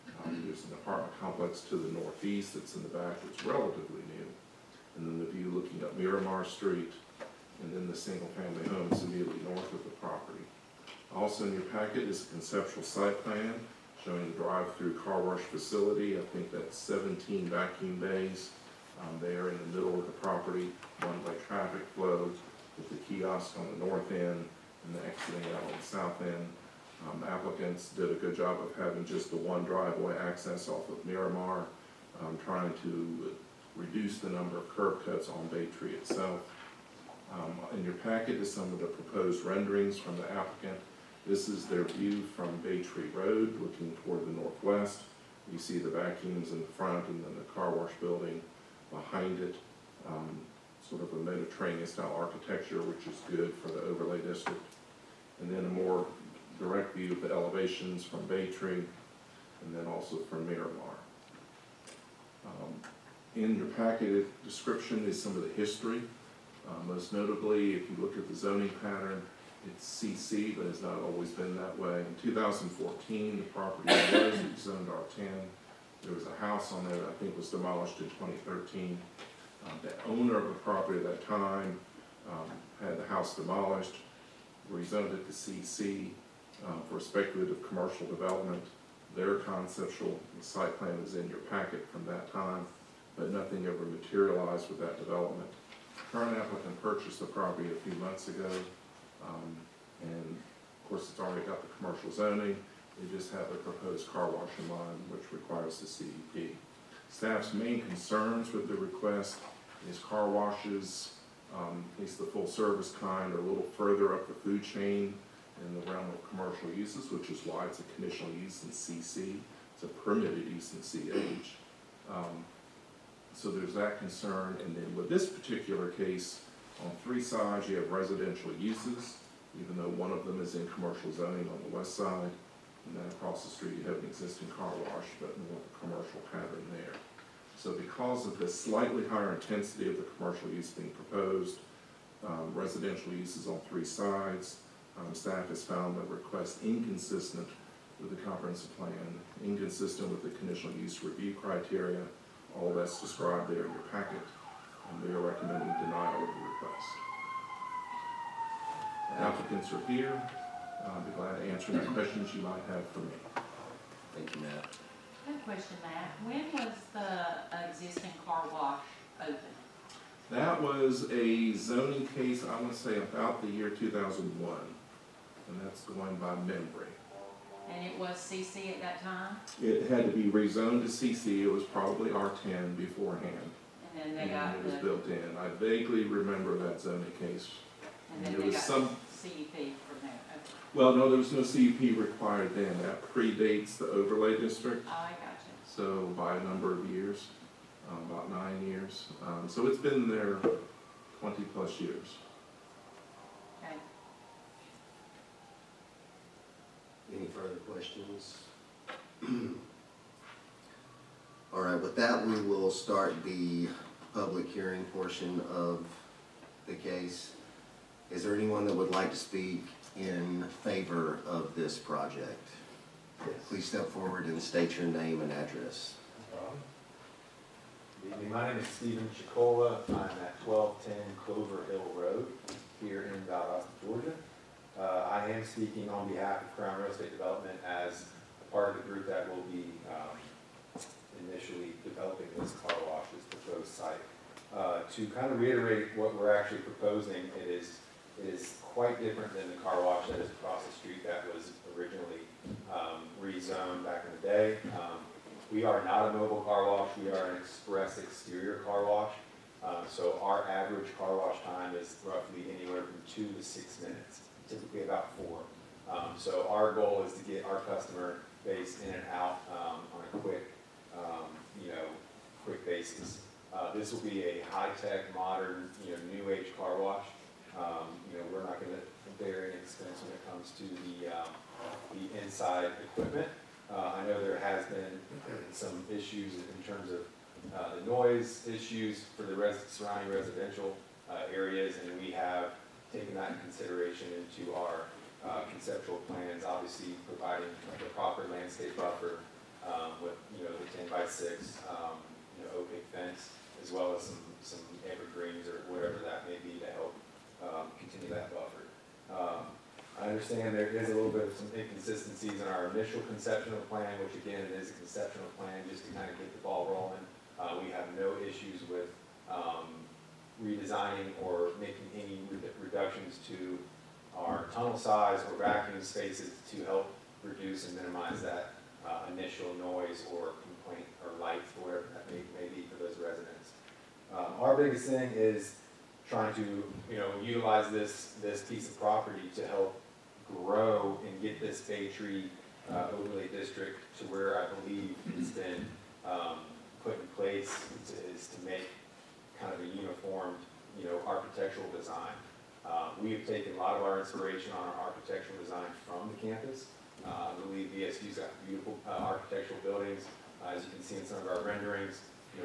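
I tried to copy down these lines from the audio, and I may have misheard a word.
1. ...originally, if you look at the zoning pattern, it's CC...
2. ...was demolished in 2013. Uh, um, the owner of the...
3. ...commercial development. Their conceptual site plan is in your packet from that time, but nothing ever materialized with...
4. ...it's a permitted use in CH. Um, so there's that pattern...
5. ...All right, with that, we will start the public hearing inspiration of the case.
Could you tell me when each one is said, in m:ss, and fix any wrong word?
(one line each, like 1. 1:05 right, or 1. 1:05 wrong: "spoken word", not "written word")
1. 1:07 wrong: "notably", not "originally"
2. 1:17 right
3. 1:27 right
4. 1:59 wrong: "concern", not "pattern"
5. 3:31 wrong: "portion", not "inspiration".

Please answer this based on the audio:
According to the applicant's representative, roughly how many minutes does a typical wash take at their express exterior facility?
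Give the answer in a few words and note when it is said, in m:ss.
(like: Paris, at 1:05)
4, at 4:25.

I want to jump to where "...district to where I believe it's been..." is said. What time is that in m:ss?
5:43.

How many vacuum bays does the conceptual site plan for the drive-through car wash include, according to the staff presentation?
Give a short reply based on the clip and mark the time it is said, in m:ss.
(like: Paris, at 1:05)
17, at 0:16.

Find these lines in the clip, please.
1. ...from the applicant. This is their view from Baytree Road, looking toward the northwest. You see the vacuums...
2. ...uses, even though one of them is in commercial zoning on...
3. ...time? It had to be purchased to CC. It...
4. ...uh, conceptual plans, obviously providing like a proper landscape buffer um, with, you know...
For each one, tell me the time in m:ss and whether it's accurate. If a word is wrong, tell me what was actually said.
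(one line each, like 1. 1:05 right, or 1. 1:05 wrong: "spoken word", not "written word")
1. 0:39 right
2. 2:08 right
3. 2:59 wrong: "rezoned", not "purchased"
4. 4:55 right.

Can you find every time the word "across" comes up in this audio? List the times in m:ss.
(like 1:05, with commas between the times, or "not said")
2:13, 4:10.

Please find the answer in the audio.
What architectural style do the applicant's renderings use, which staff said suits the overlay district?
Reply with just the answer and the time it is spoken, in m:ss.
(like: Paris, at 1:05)
Mediterranean, at 0:51.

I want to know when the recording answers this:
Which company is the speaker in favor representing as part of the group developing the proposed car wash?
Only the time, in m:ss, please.
3:56.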